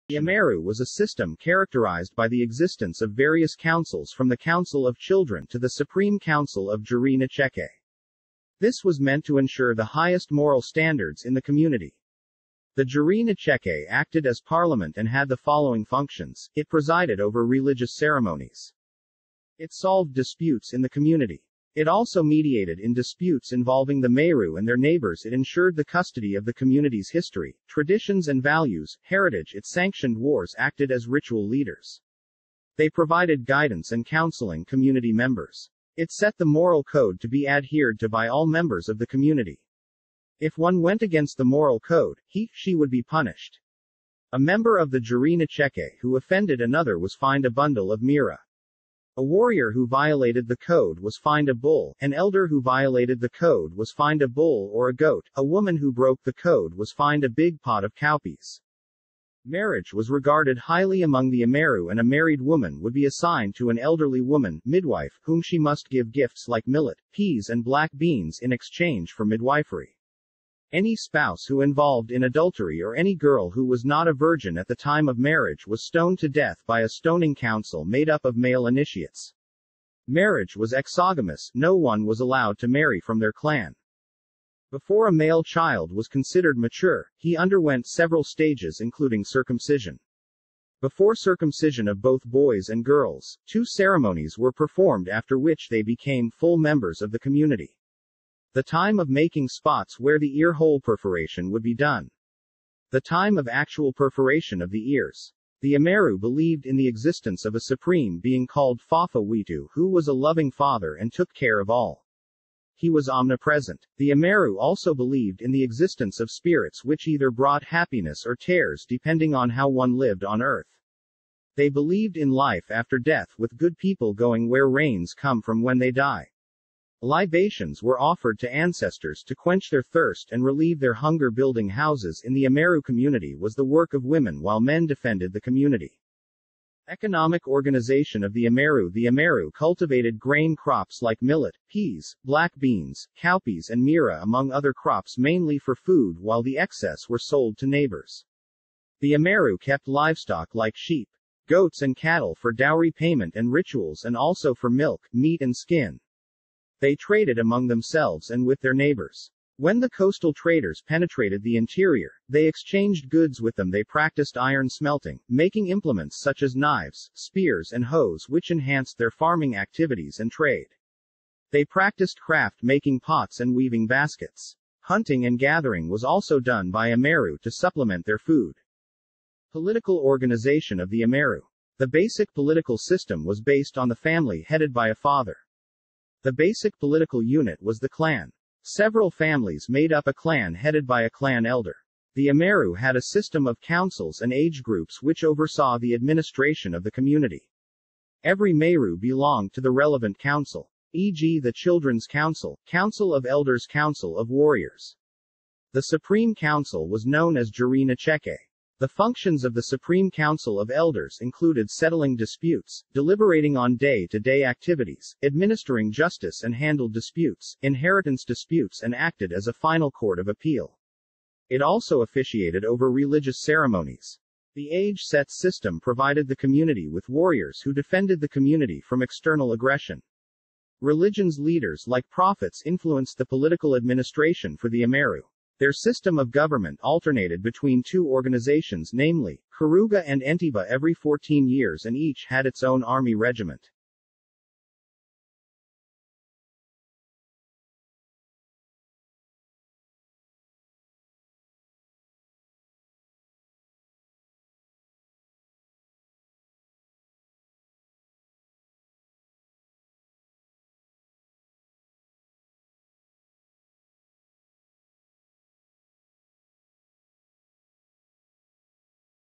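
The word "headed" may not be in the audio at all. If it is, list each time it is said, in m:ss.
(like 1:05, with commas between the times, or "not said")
3:04, 3:10.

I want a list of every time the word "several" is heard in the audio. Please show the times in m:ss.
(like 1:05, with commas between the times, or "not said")
1:27, 3:08.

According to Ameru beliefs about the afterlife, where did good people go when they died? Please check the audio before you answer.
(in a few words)
Where rains come from.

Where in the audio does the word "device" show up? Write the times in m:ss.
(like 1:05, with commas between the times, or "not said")
not said.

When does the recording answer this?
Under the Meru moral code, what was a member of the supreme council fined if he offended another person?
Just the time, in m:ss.
0:47.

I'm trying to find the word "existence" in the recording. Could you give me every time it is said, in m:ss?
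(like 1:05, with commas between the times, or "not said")
0:02, 1:46, 1:55.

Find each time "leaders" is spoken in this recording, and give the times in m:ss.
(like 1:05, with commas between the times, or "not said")
0:31, 3:51.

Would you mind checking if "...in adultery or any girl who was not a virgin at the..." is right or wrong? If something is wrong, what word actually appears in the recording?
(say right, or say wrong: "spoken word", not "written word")
right.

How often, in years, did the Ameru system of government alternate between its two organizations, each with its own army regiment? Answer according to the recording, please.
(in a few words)
14.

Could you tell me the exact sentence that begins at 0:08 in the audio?
This was meant to ensure the highest moral standards in the community.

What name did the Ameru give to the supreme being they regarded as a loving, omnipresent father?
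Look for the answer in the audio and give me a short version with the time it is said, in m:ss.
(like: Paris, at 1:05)
Fafa Witu, at 1:48.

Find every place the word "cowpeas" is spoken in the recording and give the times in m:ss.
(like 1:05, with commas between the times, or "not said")
0:57, 2:23.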